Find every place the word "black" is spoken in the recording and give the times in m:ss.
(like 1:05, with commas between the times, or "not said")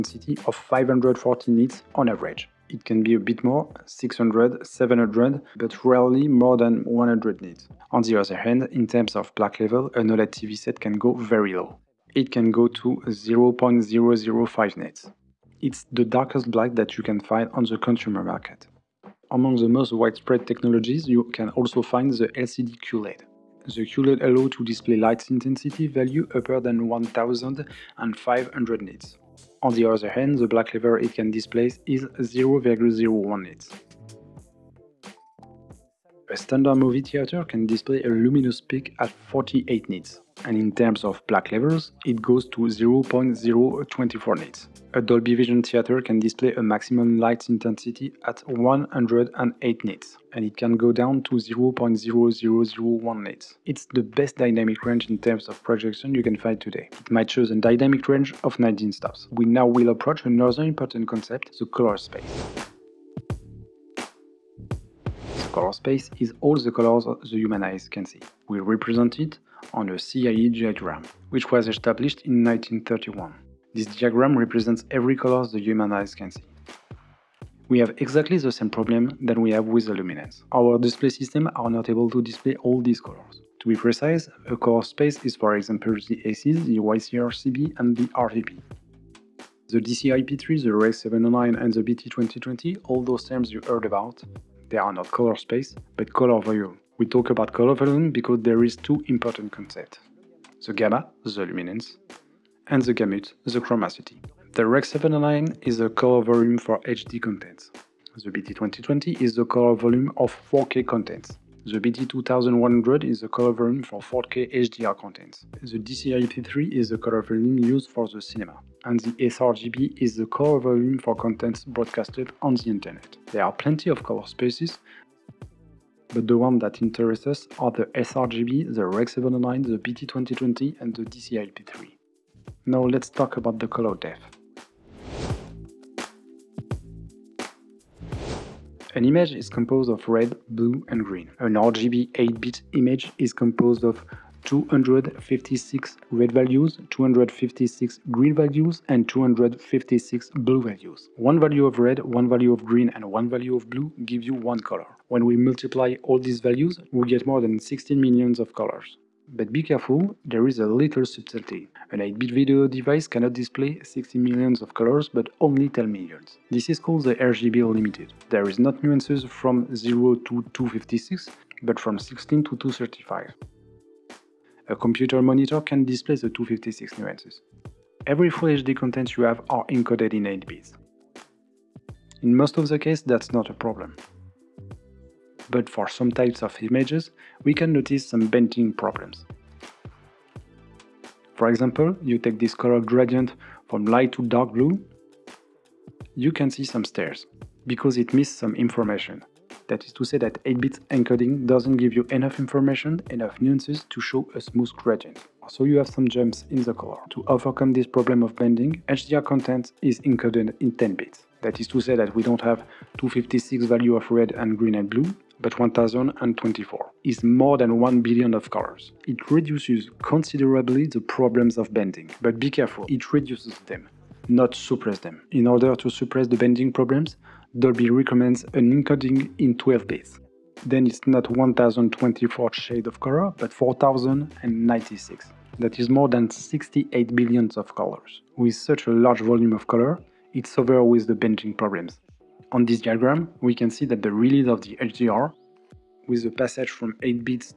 0:09, 0:16, 0:30, 0:41.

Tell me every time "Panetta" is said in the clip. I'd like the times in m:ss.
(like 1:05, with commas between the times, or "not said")
not said.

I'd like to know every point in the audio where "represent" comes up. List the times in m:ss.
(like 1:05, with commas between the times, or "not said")
1:08, 1:14.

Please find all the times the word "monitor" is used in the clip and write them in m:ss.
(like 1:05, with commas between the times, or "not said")
2:55.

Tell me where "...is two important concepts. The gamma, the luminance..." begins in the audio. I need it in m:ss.
1:38.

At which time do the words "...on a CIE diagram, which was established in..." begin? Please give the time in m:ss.
1:09.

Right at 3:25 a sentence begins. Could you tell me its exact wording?
So you have some jumps in the color.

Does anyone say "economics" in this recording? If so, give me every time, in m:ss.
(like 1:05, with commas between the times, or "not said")
not said.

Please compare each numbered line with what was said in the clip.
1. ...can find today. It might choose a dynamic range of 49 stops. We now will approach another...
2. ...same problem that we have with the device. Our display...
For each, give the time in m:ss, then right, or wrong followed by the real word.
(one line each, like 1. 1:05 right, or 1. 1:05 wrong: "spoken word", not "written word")
1. 0:56 wrong: "19", not "49"
2. 1:18 wrong: "luminance", not "device".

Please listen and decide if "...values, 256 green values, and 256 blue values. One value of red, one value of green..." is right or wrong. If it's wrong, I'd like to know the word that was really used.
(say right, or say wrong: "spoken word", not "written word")
right.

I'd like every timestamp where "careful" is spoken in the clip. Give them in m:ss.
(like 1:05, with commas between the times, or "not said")
2:39, 3:42.